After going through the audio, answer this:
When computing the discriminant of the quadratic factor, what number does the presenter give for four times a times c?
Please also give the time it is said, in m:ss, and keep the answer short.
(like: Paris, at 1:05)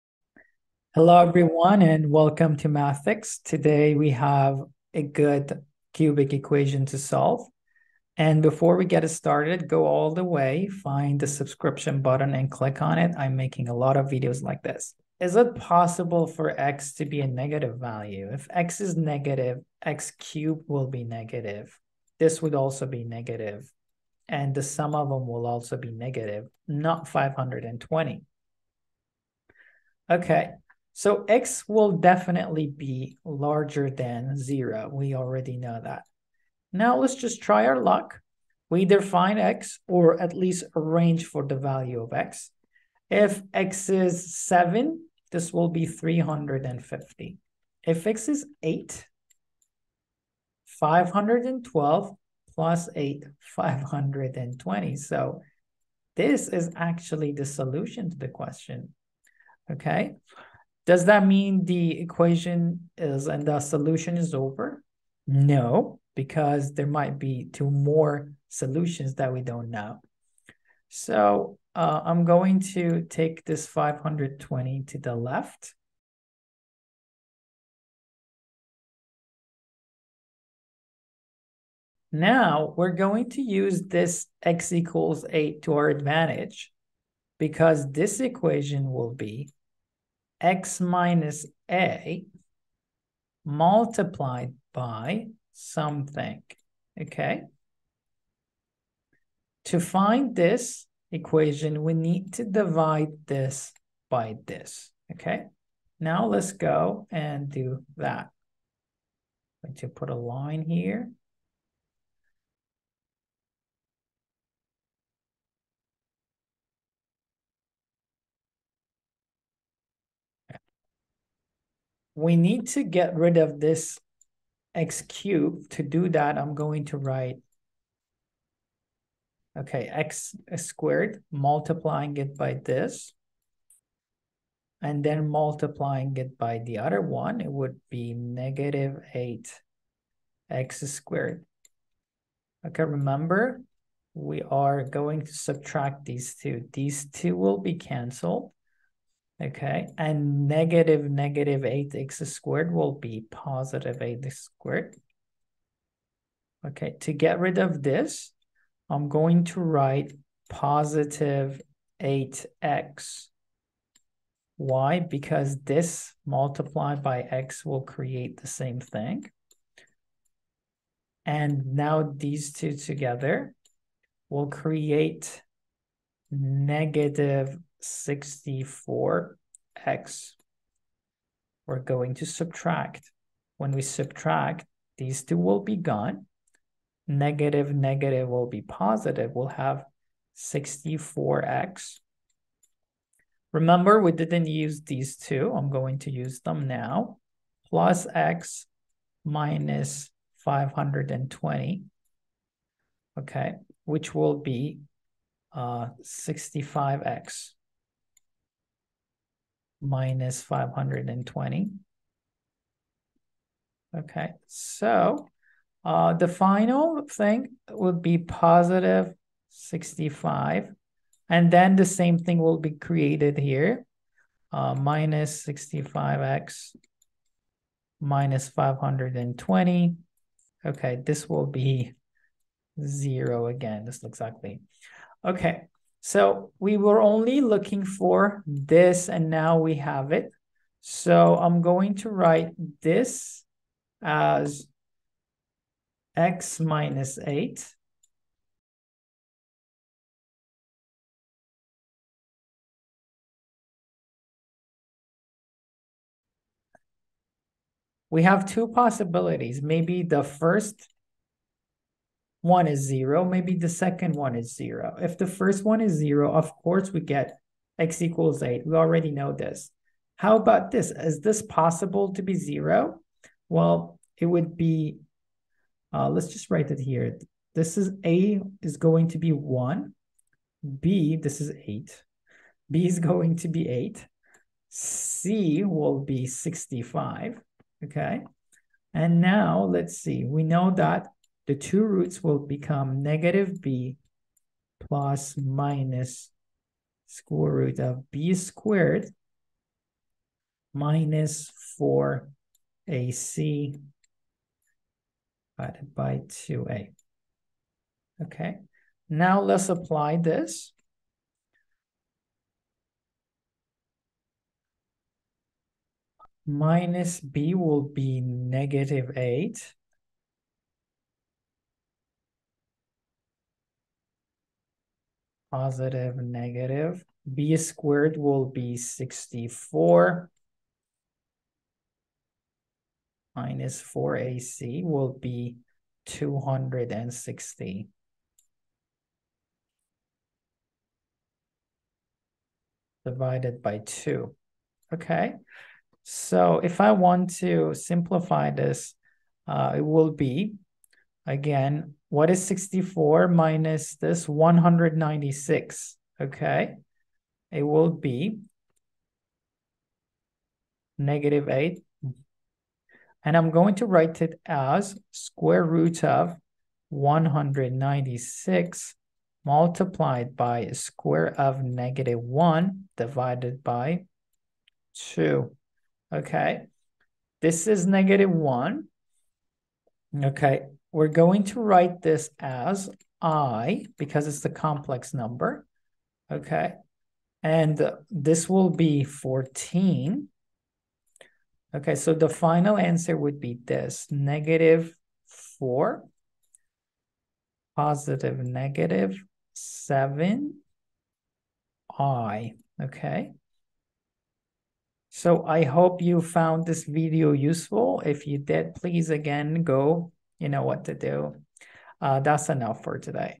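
260, at 5:36.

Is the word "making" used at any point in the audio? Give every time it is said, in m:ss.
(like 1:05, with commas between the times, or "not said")
0:13.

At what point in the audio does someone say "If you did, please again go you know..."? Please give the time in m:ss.
6:48.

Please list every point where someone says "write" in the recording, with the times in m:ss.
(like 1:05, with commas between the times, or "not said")
2:06, 2:39, 4:02, 4:36, 6:03, 6:21.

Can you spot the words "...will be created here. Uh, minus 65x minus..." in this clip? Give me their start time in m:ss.
3:42.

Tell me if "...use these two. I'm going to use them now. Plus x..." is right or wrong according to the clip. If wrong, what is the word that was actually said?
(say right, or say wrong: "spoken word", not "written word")
right.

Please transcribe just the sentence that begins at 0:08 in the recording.
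And before we get started, go all the way, find the subscription button and click on it.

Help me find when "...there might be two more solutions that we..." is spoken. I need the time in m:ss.
1:06.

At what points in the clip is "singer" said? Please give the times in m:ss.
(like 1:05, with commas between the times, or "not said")
not said.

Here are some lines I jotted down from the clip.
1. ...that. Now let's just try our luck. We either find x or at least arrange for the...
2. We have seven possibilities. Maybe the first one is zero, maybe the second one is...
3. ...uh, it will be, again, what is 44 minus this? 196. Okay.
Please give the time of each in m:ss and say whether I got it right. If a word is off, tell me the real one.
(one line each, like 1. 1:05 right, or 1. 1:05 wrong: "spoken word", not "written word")
1. 0:35 right
2. 4:18 wrong: "two", not "seven"
3. 5:49 wrong: "64", not "44".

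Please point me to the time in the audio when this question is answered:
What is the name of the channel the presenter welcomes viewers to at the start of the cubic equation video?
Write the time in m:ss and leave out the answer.
0:02.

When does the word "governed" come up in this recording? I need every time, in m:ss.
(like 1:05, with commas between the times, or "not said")
not said.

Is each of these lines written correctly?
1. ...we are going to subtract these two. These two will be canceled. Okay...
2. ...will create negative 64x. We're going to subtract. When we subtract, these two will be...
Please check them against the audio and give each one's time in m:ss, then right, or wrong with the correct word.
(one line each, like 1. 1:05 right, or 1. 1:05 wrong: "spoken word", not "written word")
1. 2:24 right
2. 2:54 right.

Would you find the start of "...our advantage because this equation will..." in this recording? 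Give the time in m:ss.
1:25.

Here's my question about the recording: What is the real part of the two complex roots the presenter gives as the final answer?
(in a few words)
-4.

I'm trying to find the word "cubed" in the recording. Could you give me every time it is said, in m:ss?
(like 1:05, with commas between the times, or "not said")
0:20, 2:05.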